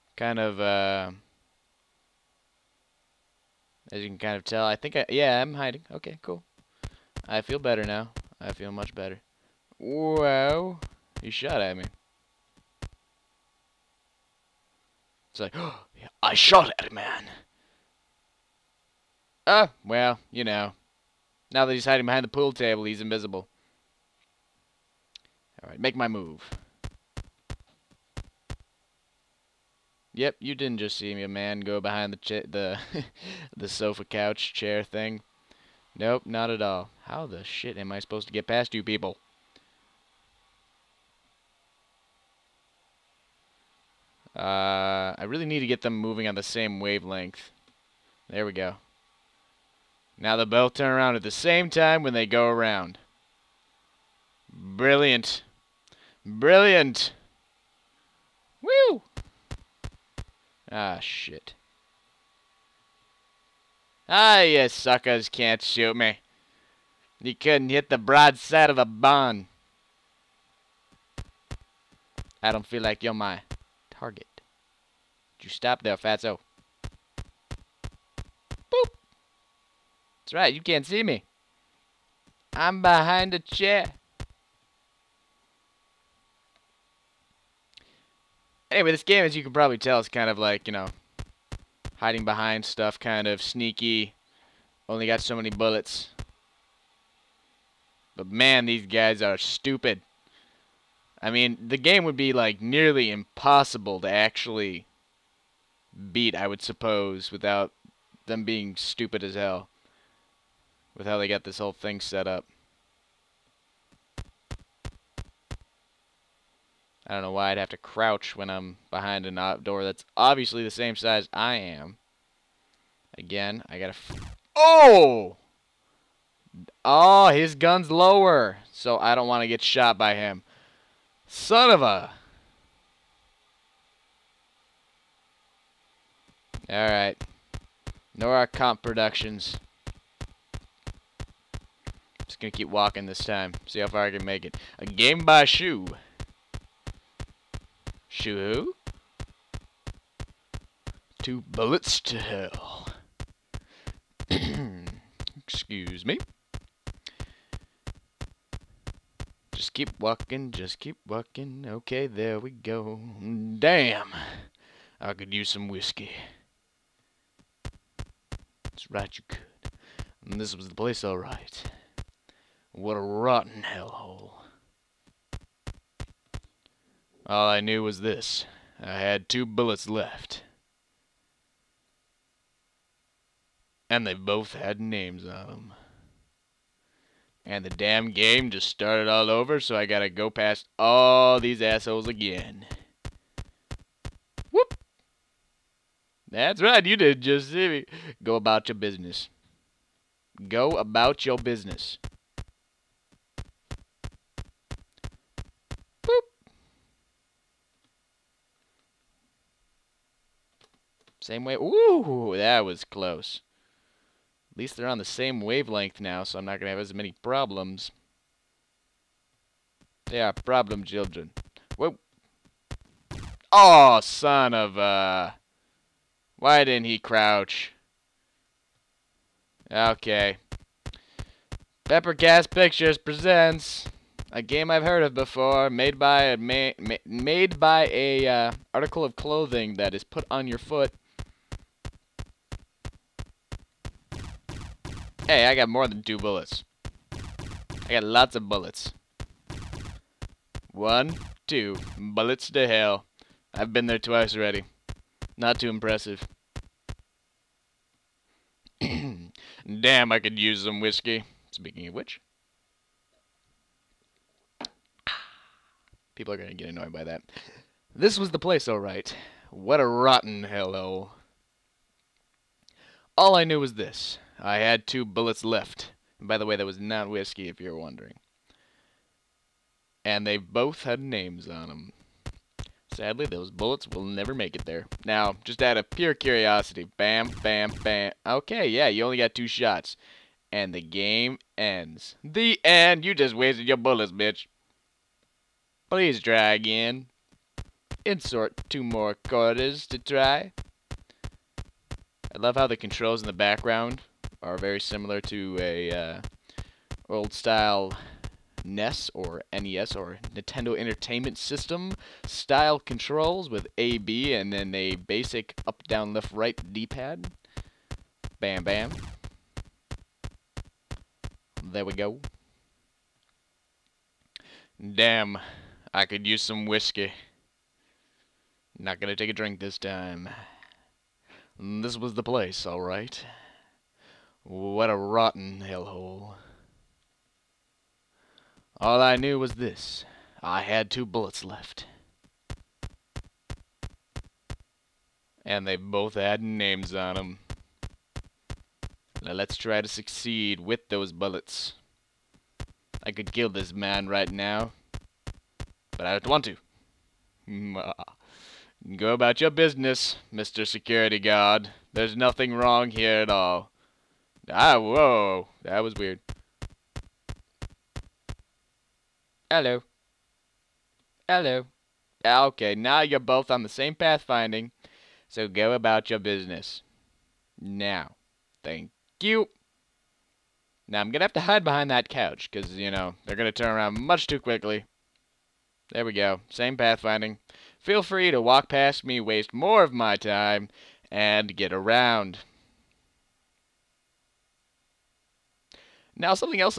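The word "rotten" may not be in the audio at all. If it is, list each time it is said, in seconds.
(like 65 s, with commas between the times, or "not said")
173 s, 269 s, 334 s.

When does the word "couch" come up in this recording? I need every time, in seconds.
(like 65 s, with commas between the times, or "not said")
34 s, 382 s.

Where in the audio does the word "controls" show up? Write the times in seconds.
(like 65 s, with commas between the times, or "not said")
302 s, 312 s.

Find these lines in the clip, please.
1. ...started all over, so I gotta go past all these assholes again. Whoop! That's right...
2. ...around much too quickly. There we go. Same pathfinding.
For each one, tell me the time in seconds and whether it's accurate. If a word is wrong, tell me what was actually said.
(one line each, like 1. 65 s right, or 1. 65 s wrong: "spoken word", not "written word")
1. 188 s right
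2. 383 s right.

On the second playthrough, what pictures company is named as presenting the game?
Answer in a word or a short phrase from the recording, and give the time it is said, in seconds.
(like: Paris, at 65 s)
Pepper Gas Pictures, at 231 s.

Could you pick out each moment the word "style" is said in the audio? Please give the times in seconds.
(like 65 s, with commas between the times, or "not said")
307 s, 312 s.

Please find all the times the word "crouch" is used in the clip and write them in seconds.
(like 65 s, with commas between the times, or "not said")
117 s, 226 s.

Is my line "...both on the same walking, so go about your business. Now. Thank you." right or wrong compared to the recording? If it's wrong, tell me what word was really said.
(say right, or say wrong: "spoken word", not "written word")
wrong: "pathfinding", not "walking".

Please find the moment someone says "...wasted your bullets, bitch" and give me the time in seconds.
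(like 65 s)
293 s.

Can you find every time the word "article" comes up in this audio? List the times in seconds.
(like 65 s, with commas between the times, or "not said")
238 s.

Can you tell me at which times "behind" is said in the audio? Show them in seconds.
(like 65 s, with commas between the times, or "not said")
22 s, 31 s, 82 s, 92 s, 118 s, 381 s.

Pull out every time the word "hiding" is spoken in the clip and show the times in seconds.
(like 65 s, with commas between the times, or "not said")
5 s, 21 s, 91 s.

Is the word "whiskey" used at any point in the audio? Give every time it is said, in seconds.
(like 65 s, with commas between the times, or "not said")
165 s, 260 s, 277 s, 326 s.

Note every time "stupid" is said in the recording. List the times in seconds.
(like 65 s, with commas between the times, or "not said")
99 s, 108 s.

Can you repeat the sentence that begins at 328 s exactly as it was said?
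Not gonna take a drink this time.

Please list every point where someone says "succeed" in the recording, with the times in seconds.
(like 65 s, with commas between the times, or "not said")
349 s.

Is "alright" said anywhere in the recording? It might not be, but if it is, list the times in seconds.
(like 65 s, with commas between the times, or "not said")
25 s, 136 s, 171 s, 268 s, 332 s.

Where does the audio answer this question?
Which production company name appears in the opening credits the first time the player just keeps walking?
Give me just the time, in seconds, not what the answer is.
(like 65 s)
138 s.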